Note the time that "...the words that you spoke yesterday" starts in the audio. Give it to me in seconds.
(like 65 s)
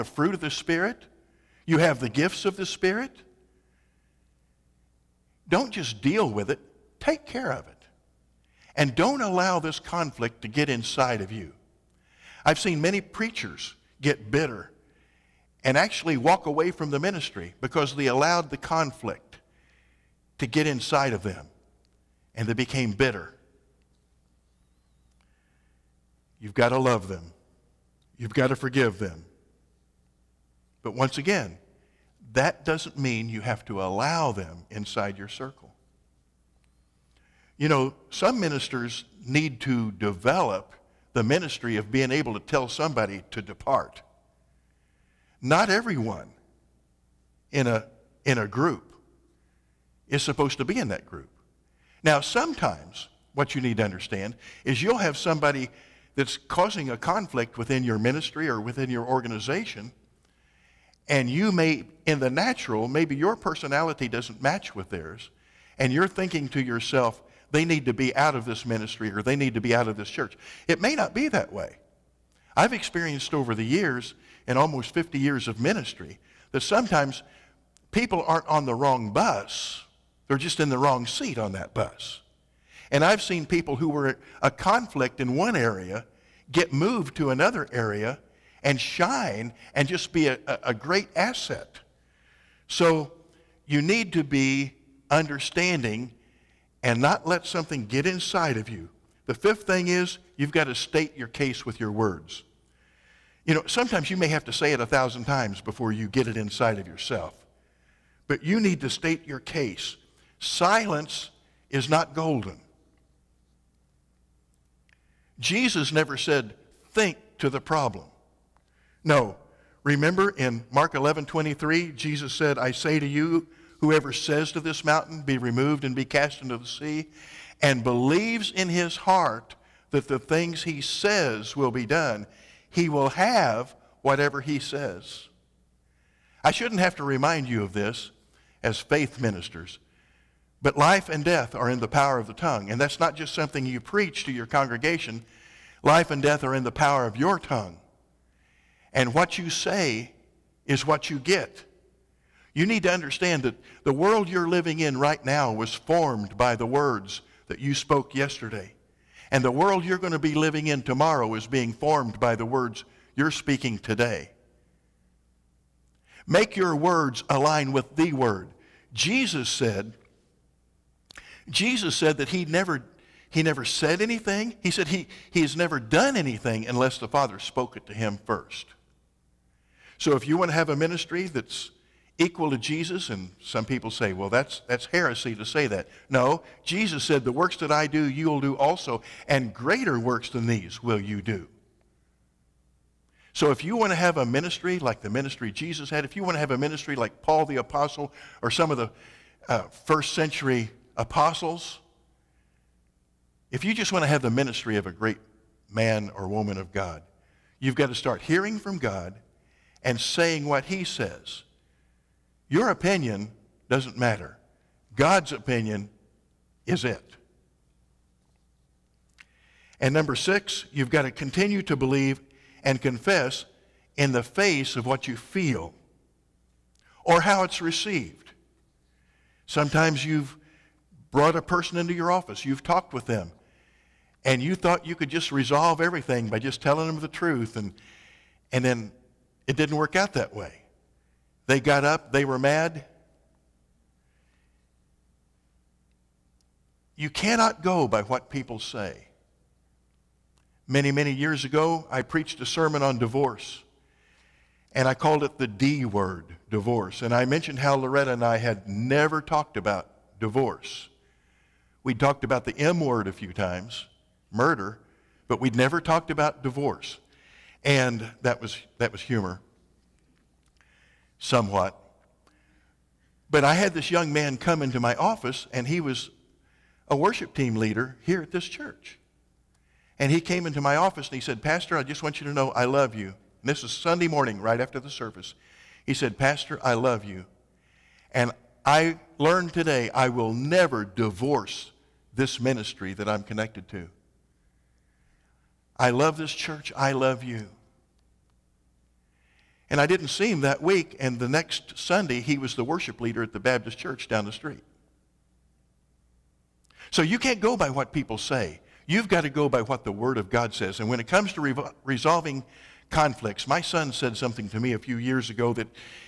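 156 s.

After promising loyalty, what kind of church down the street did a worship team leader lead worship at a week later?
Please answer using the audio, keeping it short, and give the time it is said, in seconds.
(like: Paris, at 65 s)
Baptist church, at 303 s.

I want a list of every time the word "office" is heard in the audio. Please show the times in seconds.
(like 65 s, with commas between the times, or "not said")
232 s, 274 s, 280 s.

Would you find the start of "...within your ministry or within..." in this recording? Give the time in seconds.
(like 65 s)
57 s.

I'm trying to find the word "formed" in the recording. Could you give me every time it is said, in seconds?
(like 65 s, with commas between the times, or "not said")
155 s, 161 s.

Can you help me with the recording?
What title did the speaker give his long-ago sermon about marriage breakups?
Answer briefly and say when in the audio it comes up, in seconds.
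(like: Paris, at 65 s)
The D word, at 255 s.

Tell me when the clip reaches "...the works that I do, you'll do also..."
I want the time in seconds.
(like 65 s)
187 s.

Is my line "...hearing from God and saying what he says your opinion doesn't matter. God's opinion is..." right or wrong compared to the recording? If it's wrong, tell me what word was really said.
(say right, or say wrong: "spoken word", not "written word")
right.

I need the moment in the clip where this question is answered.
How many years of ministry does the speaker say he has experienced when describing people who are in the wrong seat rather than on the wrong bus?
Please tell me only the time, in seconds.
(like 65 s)
74 s.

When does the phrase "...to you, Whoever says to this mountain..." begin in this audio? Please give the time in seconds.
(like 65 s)
122 s.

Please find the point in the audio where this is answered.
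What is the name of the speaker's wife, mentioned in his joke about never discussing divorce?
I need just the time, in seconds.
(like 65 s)
257 s.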